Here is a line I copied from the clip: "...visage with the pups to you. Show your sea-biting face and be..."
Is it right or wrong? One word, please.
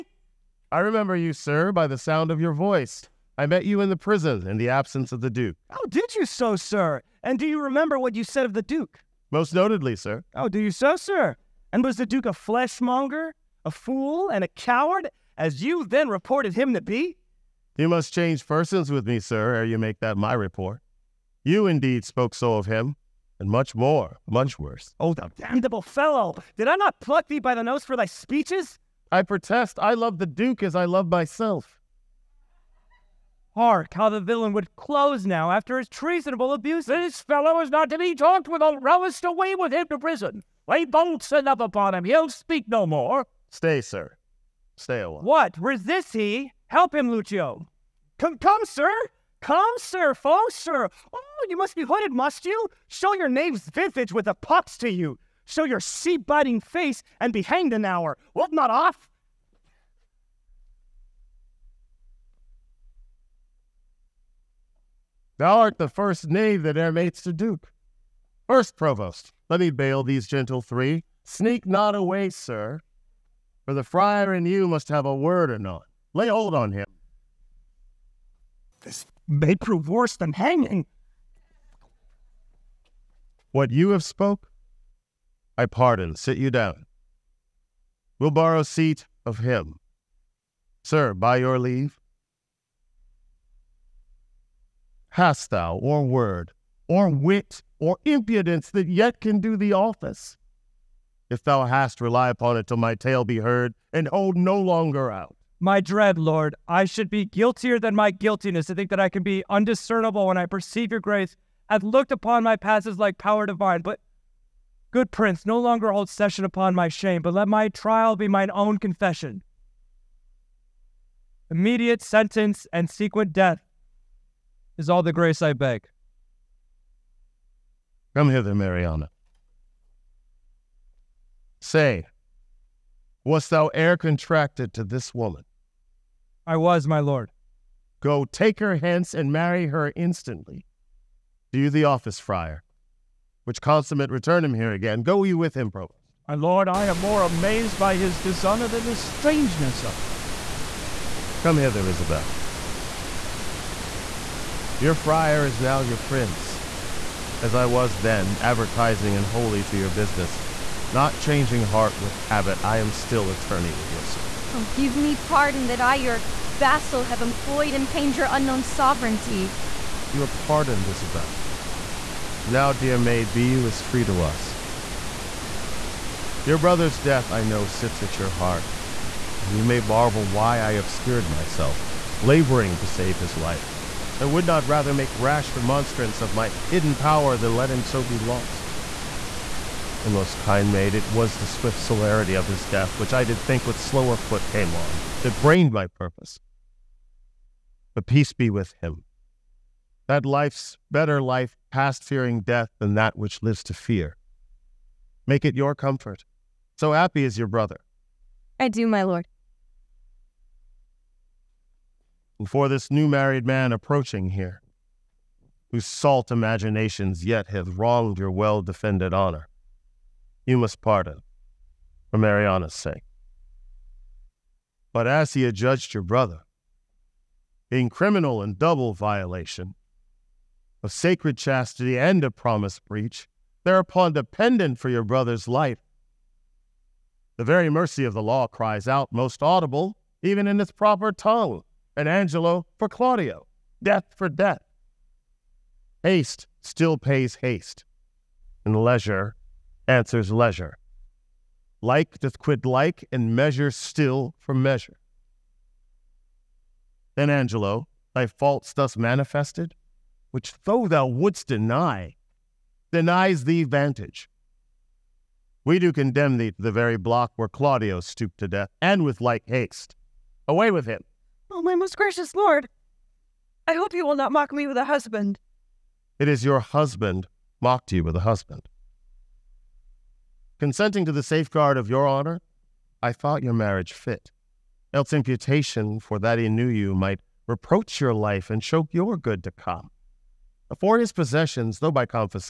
right.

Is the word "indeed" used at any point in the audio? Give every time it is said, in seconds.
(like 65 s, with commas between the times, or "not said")
21 s.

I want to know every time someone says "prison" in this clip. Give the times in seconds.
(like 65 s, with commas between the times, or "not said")
3 s, 39 s.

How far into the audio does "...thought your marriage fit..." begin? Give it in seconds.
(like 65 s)
283 s.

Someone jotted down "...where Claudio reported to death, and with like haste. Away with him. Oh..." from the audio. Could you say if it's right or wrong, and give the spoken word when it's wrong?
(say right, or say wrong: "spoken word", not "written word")
wrong: "stooped", not "reported".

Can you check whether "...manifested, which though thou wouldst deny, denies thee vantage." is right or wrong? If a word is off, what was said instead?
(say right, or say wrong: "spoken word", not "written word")
right.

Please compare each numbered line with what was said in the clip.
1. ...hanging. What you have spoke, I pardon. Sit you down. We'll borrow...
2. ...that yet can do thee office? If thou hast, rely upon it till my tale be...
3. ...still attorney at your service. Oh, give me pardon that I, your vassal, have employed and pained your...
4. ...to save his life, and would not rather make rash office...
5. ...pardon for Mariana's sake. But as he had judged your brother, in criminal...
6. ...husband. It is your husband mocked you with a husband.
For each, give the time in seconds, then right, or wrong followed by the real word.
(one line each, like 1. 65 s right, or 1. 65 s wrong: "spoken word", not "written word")
1. 80 s right
2. 98 s right
3. 162 s right
4. 182 s wrong: "remonstrance", not "office"
5. 220 s right
6. 274 s right.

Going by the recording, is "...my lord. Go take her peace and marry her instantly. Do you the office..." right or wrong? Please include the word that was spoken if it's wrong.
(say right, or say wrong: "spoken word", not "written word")
wrong: "hence", not "peace".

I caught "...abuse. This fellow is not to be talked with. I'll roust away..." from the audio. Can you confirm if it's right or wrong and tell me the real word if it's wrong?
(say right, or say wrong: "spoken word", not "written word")
right.